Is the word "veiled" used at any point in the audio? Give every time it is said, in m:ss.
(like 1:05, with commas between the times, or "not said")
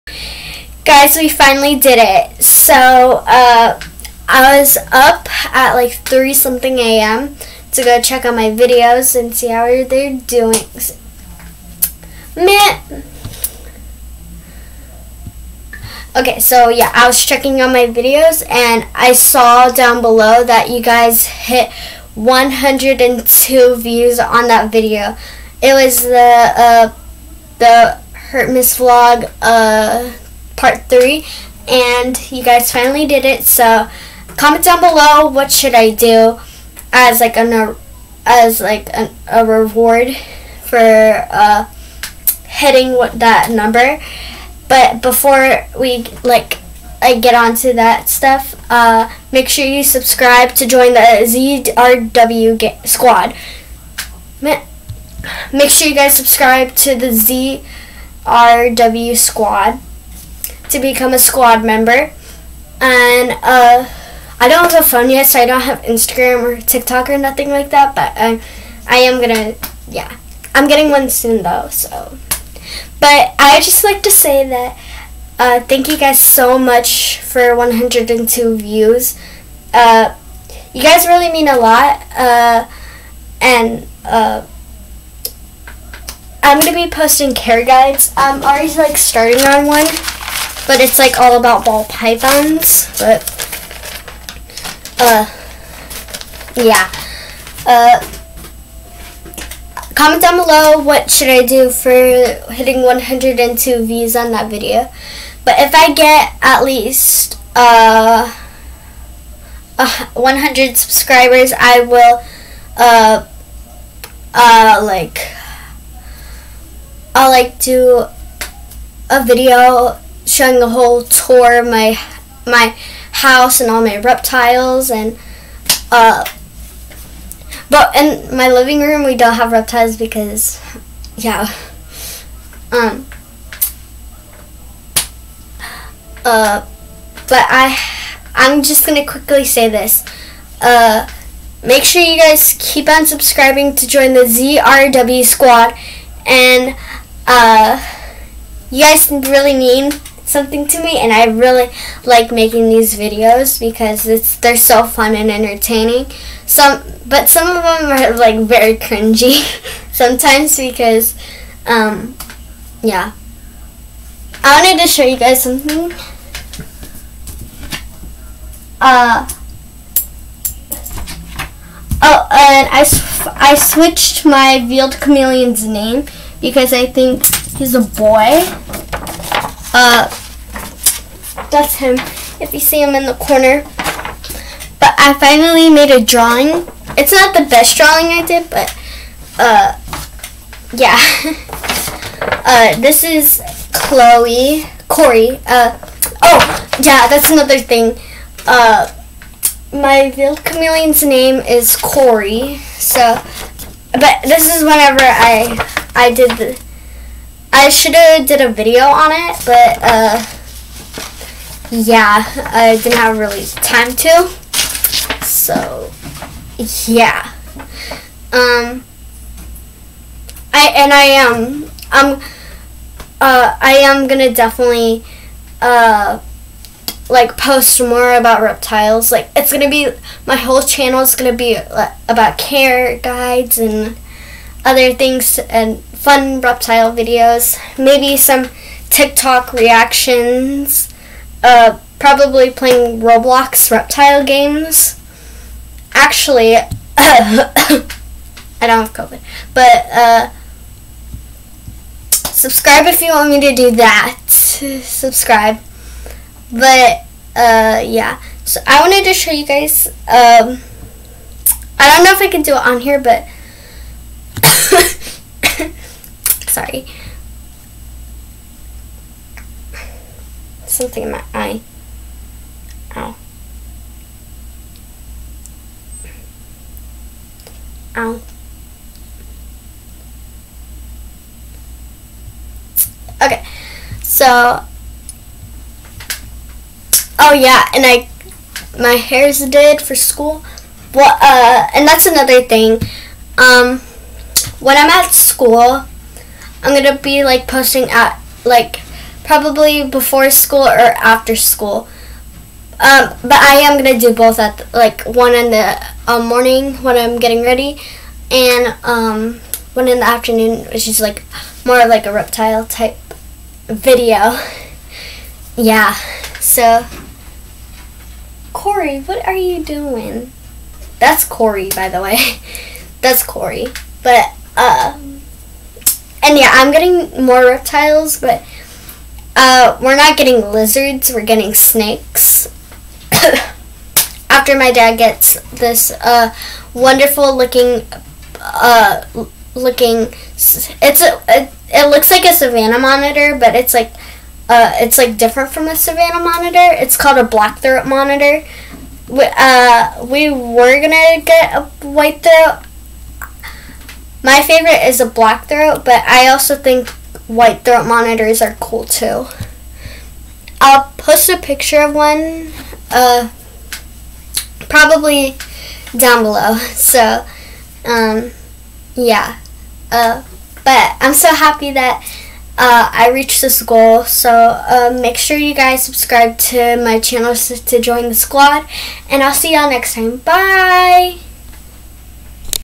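2:54.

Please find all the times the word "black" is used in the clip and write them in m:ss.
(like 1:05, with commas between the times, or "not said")
5:47, 5:55.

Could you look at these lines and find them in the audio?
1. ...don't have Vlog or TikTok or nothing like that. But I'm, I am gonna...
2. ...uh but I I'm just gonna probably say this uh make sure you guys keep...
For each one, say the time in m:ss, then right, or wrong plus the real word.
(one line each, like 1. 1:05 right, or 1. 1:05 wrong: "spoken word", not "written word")
1. 1:05 wrong: "Instagram", not "Vlog"
2. 2:16 wrong: "quickly", not "probably".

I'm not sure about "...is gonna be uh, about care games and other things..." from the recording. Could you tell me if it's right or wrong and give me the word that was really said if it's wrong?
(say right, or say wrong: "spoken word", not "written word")
wrong: "guides", not "games".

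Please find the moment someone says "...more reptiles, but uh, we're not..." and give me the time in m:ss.
5:27.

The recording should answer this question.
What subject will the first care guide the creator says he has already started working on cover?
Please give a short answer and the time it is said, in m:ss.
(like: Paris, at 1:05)
Ball pythons, at 1:31.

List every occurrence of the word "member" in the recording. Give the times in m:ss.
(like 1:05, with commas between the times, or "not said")
1:01.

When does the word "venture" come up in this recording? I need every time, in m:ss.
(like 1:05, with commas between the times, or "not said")
not said.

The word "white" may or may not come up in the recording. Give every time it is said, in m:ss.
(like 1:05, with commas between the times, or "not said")
5:51, 5:57.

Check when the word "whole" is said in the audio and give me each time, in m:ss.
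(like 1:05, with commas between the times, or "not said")
2:00, 3:50.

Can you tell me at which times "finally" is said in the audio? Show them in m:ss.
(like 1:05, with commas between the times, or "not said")
0:01, 0:32, 3:05.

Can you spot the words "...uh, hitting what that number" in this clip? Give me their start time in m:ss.
0:41.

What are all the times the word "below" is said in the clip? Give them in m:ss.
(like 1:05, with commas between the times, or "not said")
0:20, 0:34, 1:40, 6:06.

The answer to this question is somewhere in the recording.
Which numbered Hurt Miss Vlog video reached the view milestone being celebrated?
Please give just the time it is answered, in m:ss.
0:30.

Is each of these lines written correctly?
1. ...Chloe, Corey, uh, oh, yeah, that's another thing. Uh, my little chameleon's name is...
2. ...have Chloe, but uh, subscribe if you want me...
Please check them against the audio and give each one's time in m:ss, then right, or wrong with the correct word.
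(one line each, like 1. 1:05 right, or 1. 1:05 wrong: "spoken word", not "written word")
1. 3:13 right
2. 4:08 wrong: "COVID", not "Chloe".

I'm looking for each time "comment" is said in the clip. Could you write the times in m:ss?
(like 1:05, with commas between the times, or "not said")
0:34, 1:39.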